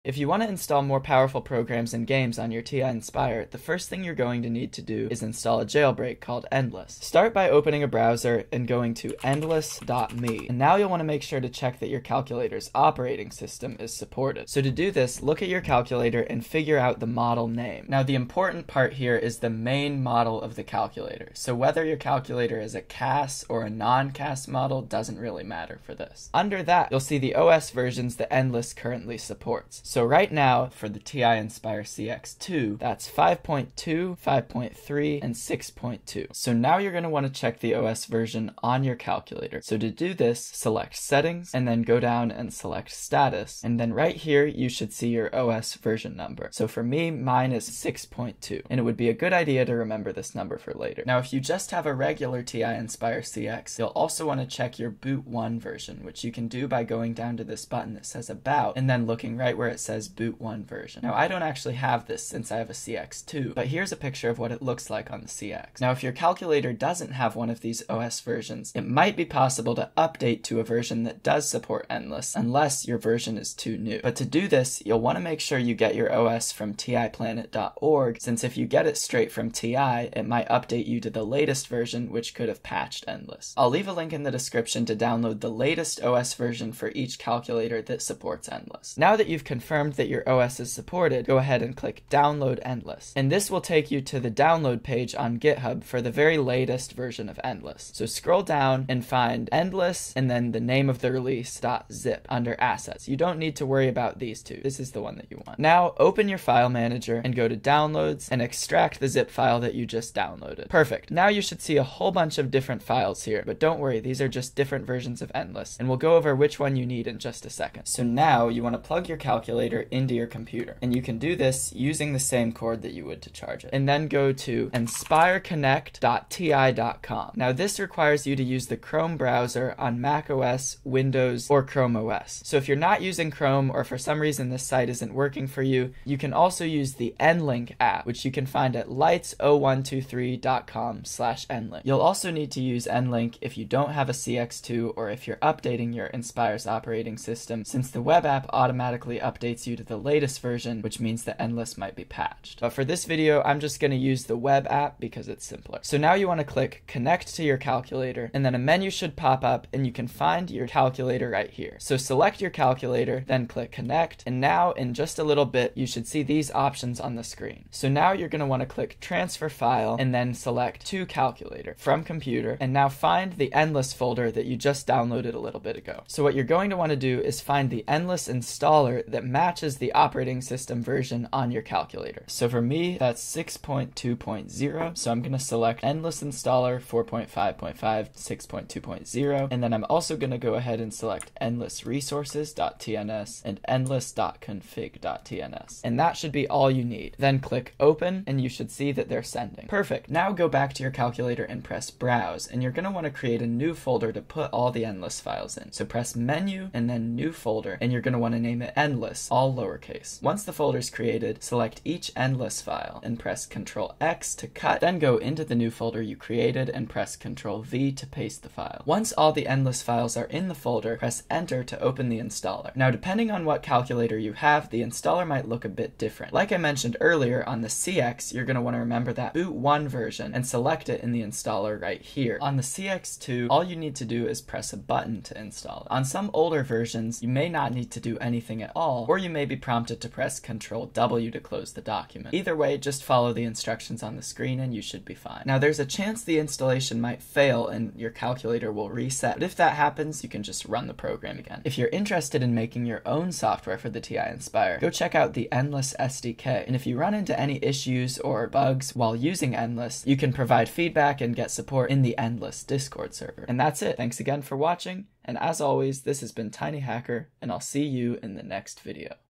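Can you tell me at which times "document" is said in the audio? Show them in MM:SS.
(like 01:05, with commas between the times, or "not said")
04:01.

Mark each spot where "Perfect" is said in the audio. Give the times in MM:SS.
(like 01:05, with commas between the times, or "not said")
01:50, 03:19.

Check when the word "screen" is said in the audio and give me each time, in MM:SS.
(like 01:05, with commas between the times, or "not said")
02:47, 04:04.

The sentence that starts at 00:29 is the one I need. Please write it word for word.
So right now for the TI Inspire CX II, that's 5.2, 5.3, and 6.2.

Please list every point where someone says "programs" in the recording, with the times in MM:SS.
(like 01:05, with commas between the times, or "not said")
00:01, 04:10.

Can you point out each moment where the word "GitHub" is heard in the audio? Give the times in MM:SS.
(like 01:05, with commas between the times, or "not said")
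01:35.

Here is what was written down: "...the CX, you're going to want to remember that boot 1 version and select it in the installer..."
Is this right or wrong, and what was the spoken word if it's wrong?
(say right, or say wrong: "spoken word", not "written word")
right.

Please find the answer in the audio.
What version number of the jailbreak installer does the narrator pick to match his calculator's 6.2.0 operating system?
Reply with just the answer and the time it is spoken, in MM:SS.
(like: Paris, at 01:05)
4.5.5, at 03:06.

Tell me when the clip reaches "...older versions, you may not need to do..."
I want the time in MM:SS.
03:56.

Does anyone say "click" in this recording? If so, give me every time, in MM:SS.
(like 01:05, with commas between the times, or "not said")
01:31, 02:36, 02:43, 02:48, 03:17.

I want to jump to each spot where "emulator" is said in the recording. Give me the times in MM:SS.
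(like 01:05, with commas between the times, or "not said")
01:59.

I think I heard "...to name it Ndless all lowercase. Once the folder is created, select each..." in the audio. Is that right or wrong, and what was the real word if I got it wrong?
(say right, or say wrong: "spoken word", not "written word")
right.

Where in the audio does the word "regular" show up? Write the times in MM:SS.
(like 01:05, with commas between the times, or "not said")
00:51.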